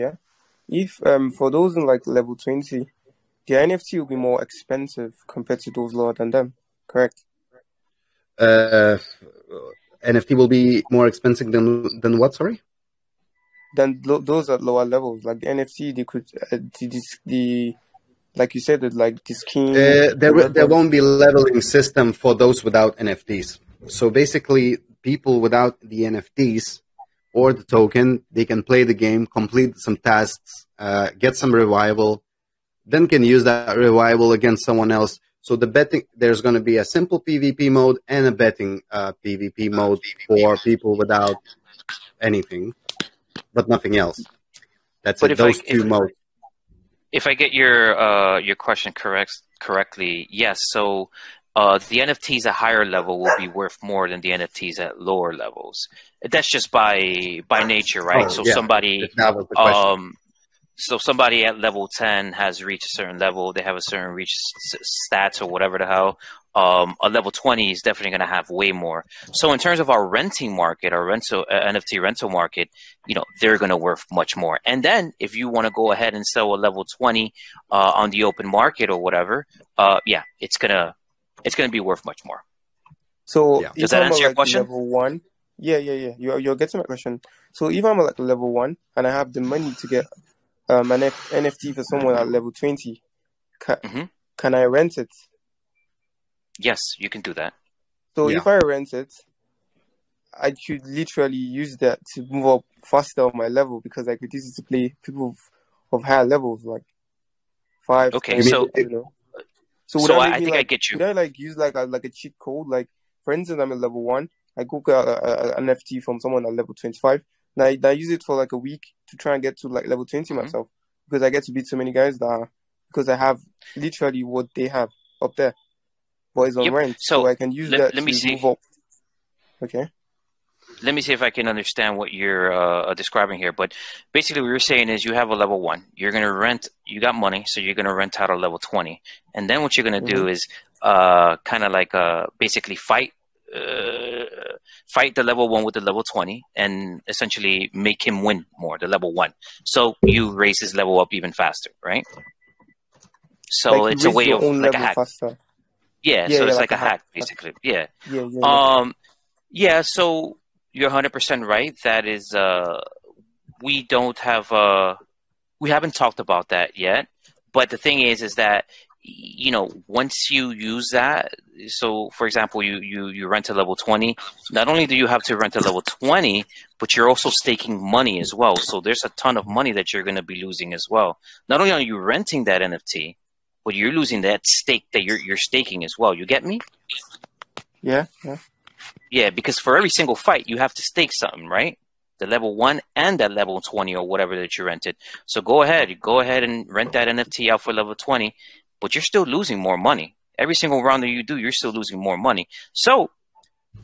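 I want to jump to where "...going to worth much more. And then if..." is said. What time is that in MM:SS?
01:13.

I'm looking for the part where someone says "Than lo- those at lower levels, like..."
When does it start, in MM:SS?
00:13.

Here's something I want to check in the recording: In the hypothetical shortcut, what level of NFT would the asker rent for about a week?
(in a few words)
25.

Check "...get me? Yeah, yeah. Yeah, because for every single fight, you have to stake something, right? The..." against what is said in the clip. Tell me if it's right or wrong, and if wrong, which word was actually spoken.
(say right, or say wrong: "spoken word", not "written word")
right.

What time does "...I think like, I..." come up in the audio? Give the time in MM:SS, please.
01:50.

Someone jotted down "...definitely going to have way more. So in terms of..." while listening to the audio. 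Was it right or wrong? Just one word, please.
right.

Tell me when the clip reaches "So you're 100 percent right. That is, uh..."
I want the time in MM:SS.
02:39.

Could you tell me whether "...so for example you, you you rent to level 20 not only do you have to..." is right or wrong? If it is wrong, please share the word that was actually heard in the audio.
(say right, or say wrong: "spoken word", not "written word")
right.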